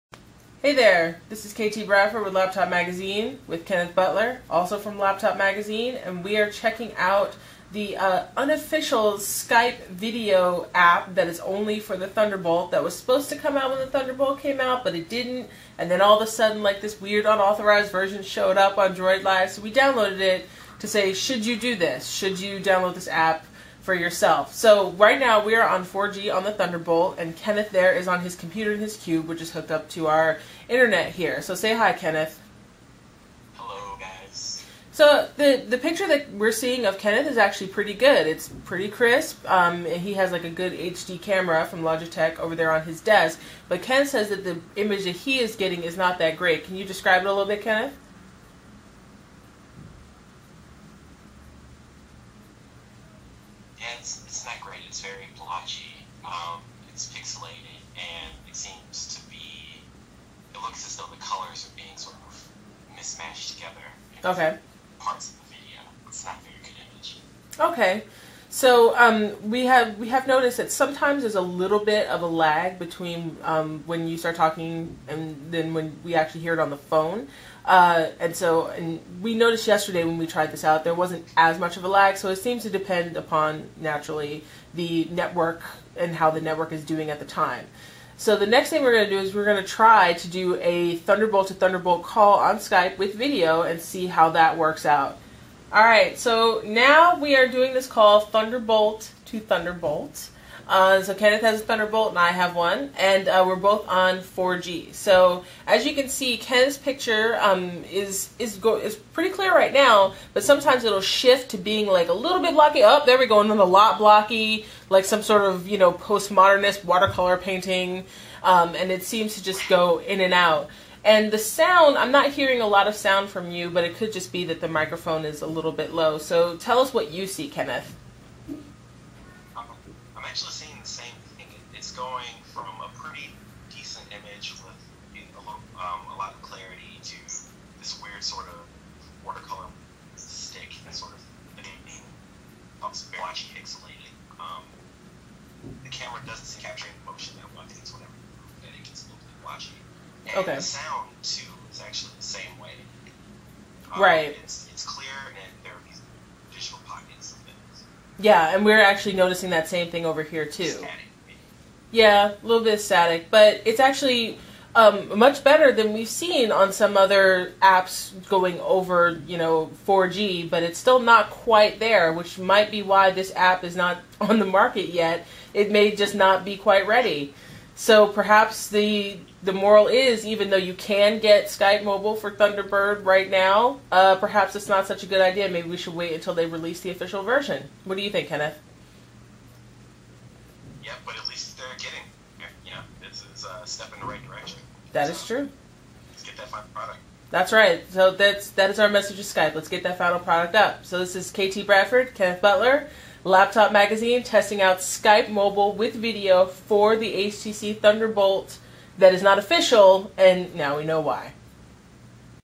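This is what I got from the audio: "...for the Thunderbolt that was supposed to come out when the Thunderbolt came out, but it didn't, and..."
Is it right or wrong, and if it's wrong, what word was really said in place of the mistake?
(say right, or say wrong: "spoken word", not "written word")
right.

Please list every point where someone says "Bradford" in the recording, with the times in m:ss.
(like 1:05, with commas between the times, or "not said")
0:01, 3:21.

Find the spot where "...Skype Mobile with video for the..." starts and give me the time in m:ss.
3:24.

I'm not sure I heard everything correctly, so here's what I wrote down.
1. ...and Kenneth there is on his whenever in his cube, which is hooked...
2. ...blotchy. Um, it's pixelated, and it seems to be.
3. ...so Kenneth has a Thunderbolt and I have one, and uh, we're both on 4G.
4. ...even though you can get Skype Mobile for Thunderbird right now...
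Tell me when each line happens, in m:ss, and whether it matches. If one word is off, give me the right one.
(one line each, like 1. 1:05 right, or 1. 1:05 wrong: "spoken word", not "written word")
1. 0:27 wrong: "computer", not "whenever"
2. 0:55 right
3. 1:41 right
4. 3:00 right.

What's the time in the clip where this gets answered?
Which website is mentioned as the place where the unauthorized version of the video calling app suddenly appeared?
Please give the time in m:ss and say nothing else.
0:18.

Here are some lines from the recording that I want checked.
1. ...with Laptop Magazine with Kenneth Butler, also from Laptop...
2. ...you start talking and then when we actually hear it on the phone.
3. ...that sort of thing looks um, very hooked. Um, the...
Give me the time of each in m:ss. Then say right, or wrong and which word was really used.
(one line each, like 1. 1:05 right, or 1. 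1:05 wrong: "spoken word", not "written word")
1. 0:02 right
2. 1:14 right
3. 2:20 wrong: "pixelated", not "hooked".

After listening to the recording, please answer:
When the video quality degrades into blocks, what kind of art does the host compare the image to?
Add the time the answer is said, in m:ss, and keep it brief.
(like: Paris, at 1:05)
postmodernist watercolor painting, at 1:55.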